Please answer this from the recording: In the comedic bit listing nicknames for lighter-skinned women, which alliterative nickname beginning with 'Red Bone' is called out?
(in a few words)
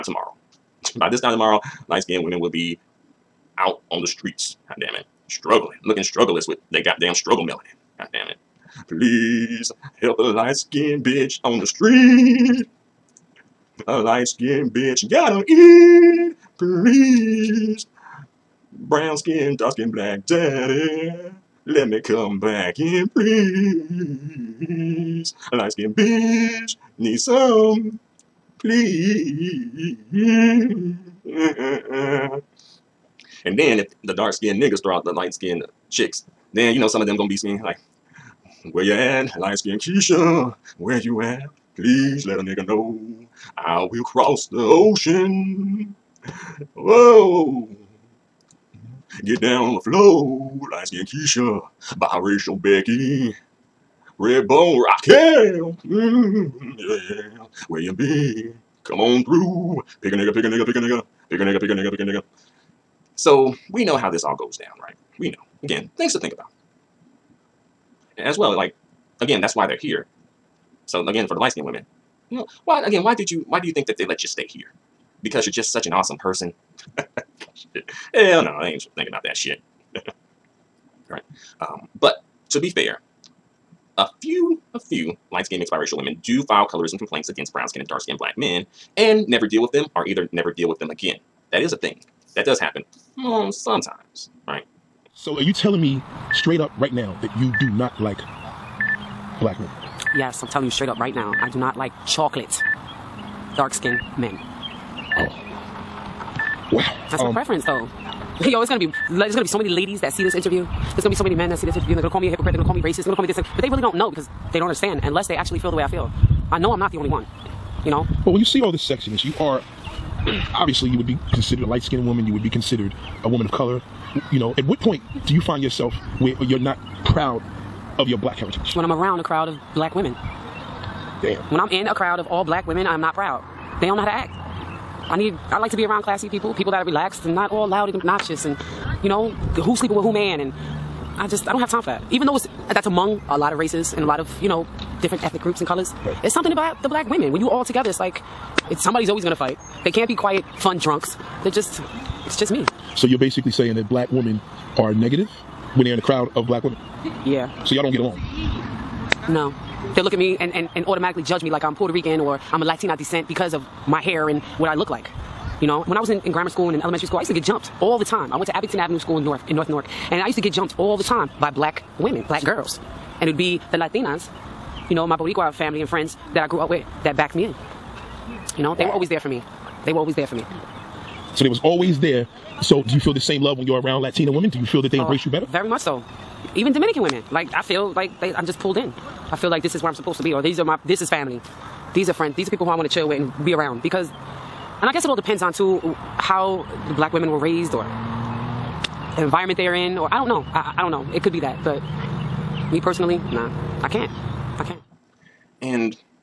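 Red Bone Raquel.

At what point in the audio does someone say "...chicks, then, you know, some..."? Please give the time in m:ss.
0:35.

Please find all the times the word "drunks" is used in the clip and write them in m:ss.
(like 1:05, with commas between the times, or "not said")
2:30.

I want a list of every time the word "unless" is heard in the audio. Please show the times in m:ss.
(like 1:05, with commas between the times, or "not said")
1:55.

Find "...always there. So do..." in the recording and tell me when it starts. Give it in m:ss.
3:01.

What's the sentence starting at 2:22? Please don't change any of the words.
Even though it's, that's among a lot of races and a lot of, you know, different ethnic groups and colors.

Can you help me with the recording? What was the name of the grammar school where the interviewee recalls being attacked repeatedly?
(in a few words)
Abington Avenue School.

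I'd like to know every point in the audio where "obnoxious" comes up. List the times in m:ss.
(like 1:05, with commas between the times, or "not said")
2:18.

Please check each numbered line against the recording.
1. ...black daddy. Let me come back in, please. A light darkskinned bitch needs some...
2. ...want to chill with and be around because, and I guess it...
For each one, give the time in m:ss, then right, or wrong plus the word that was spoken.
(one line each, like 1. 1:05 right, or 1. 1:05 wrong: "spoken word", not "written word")
1. 0:19 wrong: "skinned", not "darkskinned"
2. 3:12 right.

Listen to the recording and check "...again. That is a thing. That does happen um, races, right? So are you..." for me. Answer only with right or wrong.
wrong.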